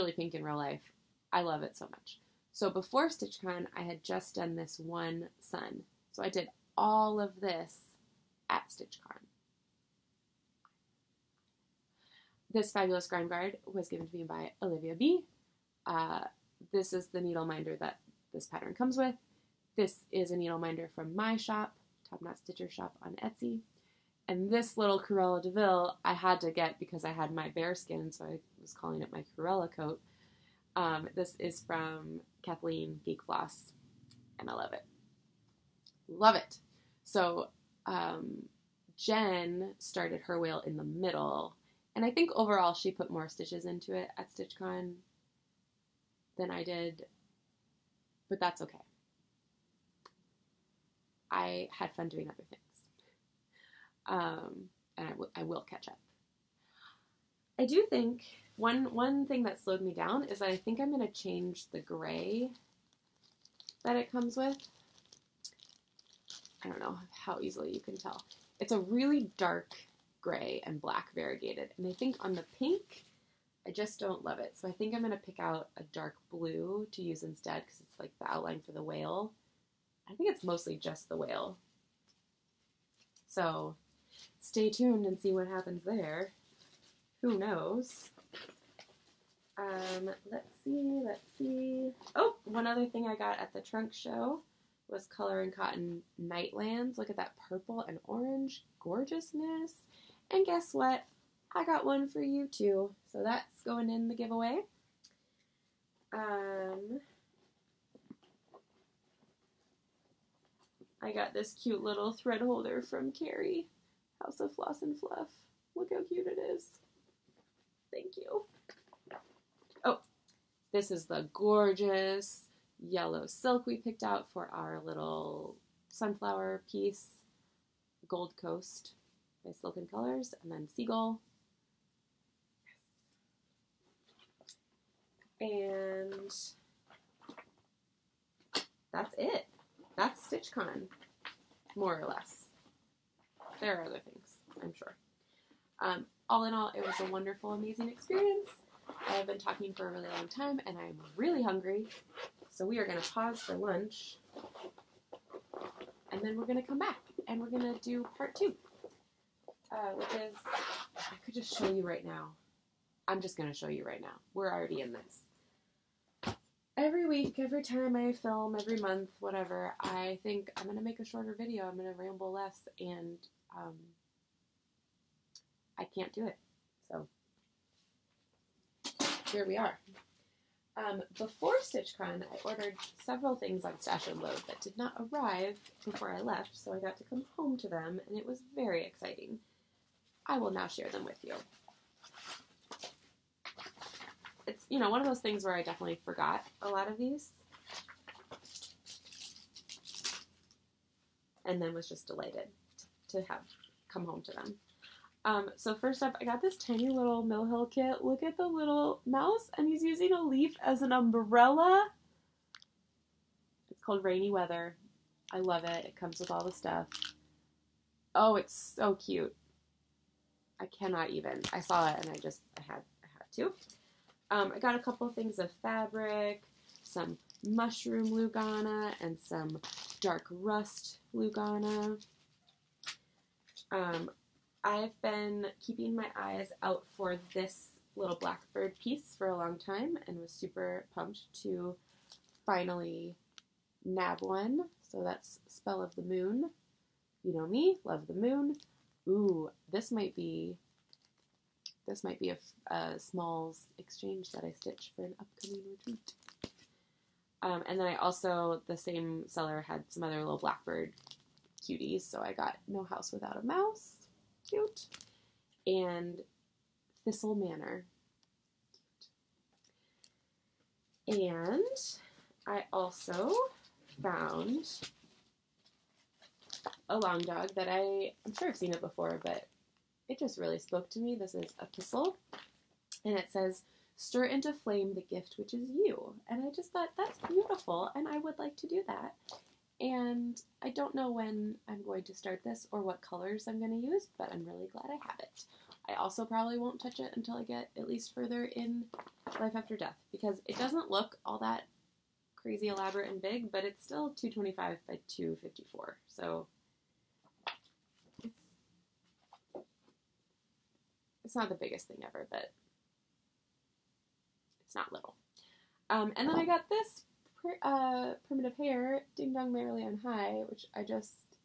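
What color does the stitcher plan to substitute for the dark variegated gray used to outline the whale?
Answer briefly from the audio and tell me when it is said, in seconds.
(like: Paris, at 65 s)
dark blue, at 75 s.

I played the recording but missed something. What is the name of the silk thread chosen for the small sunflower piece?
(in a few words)
Gold Coast.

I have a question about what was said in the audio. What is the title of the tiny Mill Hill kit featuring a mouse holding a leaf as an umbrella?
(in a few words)
Rainy Weather.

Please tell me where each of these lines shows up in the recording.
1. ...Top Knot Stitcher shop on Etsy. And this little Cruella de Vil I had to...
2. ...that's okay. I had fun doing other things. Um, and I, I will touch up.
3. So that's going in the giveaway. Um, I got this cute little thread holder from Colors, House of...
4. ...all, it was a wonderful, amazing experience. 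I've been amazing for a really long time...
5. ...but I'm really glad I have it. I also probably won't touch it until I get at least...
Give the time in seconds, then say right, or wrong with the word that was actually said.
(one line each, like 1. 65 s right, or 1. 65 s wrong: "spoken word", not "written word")
1. 22 s right
2. 48 s wrong: "catch", not "touch"
3. 103 s wrong: "Carrie", not "Colors"
4. 146 s wrong: "talking", not "amazing"
5. 294 s right.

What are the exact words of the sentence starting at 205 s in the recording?
Um, so first up, I got this tiny little Mill Hill kit.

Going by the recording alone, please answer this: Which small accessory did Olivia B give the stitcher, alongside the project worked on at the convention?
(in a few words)
grime guard.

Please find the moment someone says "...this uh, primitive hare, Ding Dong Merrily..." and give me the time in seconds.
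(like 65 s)
316 s.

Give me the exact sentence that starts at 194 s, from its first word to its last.
It's, you know, one of those things where I definitely forgot a lot of these.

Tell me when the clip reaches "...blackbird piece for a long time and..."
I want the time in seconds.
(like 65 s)
238 s.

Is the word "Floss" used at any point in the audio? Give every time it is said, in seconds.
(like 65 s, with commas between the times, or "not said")
33 s, 114 s.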